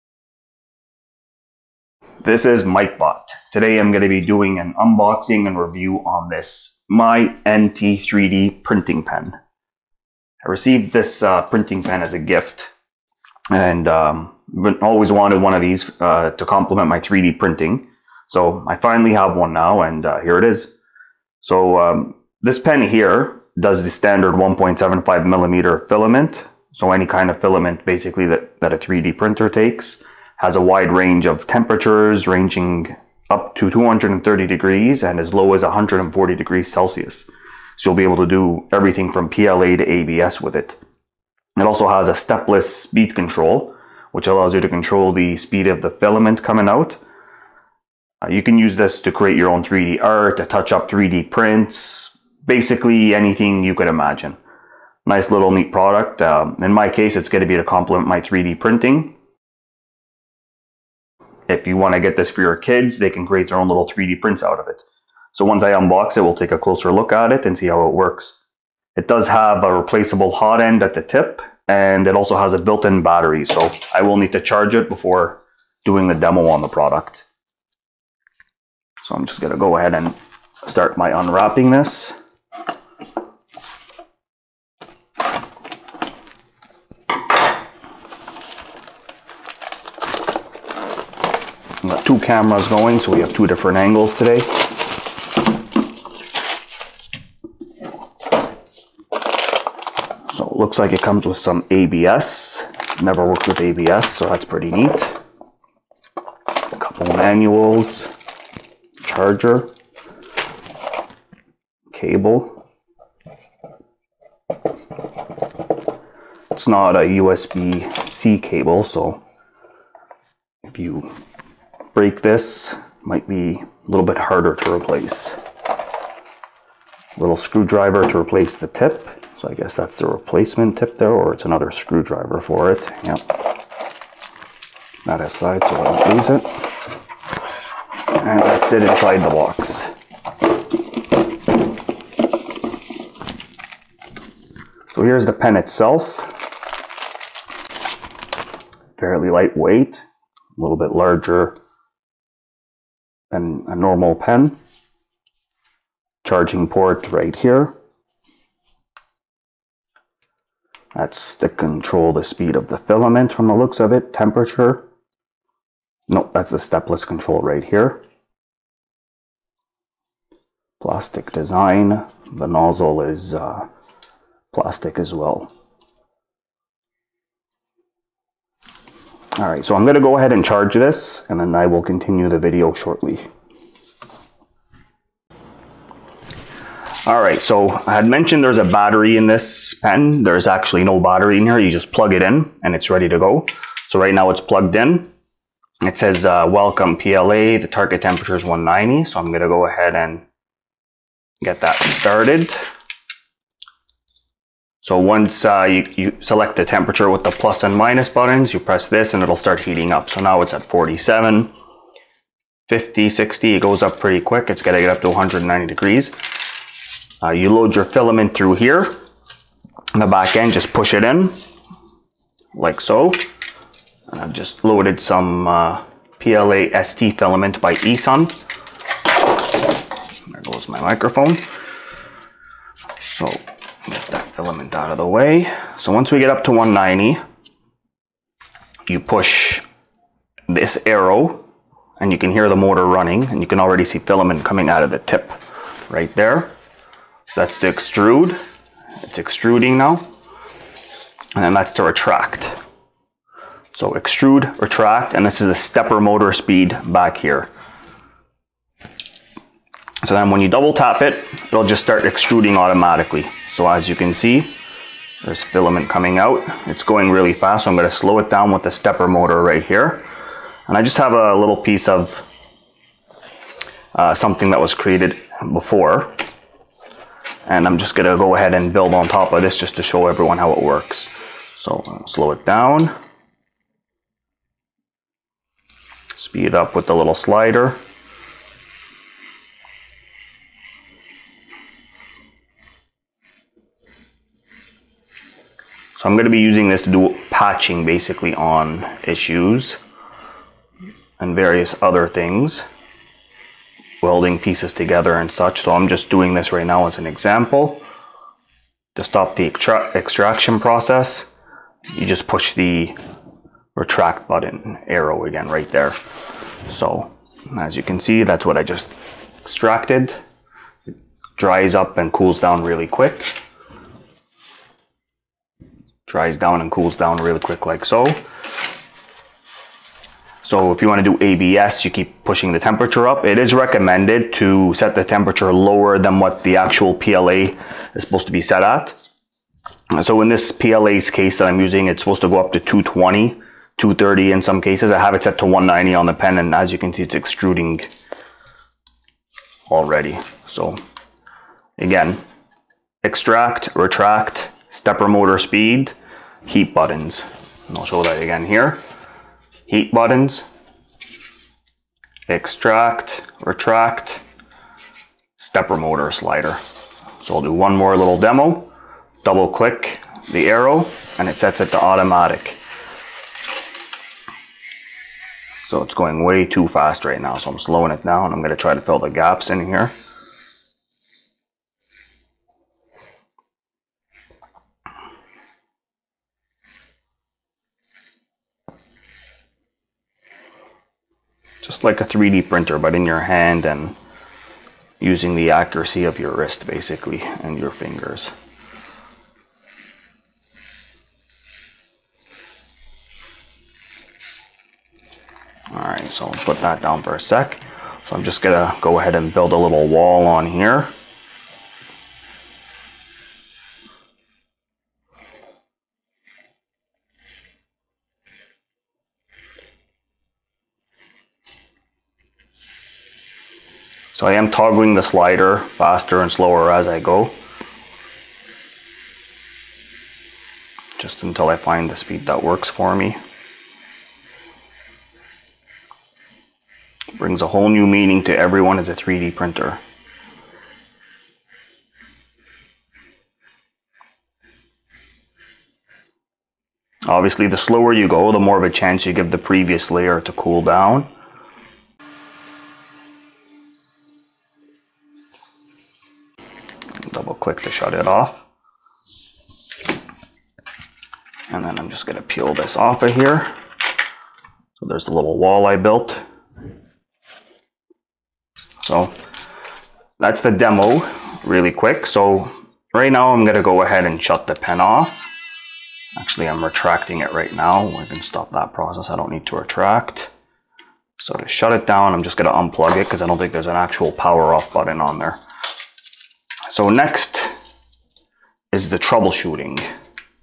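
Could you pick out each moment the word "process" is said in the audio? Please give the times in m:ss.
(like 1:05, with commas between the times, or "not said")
5:10, 7:58.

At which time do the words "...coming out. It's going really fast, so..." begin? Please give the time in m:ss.
4:25.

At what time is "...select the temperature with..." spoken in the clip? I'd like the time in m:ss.
3:26.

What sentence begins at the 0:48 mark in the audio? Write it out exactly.
Uh, you can use this to create your own 3D art, to touch up 3D prints, basically anything you could imagine.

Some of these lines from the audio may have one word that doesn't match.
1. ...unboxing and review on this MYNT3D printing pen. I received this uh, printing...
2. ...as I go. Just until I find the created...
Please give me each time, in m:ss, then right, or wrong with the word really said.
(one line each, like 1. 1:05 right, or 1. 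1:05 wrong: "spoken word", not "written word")
1. 0:04 right
2. 7:06 wrong: "speed", not "created".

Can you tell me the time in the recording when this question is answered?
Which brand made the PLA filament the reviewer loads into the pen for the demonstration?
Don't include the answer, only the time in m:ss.
3:47.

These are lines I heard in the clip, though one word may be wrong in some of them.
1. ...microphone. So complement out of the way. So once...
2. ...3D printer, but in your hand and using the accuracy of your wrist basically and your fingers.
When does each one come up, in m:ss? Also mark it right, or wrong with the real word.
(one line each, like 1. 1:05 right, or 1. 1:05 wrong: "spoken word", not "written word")
1. 3:50 wrong: "filament", not "complement"
2. 6:32 right.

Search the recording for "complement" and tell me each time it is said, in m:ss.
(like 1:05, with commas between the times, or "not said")
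0:16, 0:57.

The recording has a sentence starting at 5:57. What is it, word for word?
And I'll show that again here.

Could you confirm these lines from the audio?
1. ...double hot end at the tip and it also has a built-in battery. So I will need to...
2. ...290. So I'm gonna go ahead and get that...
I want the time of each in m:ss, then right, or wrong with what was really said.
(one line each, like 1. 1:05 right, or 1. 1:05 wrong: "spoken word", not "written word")
1. 1:09 wrong: "replaceable", not "double"
2. 3:18 wrong: "190", not "290".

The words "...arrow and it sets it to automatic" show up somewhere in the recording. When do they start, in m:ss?
6:10.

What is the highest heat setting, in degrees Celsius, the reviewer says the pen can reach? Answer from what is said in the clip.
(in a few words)
230 degrees.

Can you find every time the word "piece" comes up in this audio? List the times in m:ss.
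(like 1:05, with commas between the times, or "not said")
4:31, 5:04.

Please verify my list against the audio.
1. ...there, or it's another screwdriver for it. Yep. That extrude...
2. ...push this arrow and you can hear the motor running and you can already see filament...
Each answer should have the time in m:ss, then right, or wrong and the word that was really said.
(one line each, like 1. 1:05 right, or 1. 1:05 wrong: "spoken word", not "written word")
1. 2:10 wrong: "aside", not "extrude"
2. 3:59 right.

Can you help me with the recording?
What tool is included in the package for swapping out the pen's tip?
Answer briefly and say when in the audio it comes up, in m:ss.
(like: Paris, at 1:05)
Little screwdriver, at 2:07.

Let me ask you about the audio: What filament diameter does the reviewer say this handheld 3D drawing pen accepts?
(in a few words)
1.75 millimeter.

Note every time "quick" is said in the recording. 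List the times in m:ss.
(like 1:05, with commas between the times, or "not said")
3:34, 5:22, 5:27, 7:51.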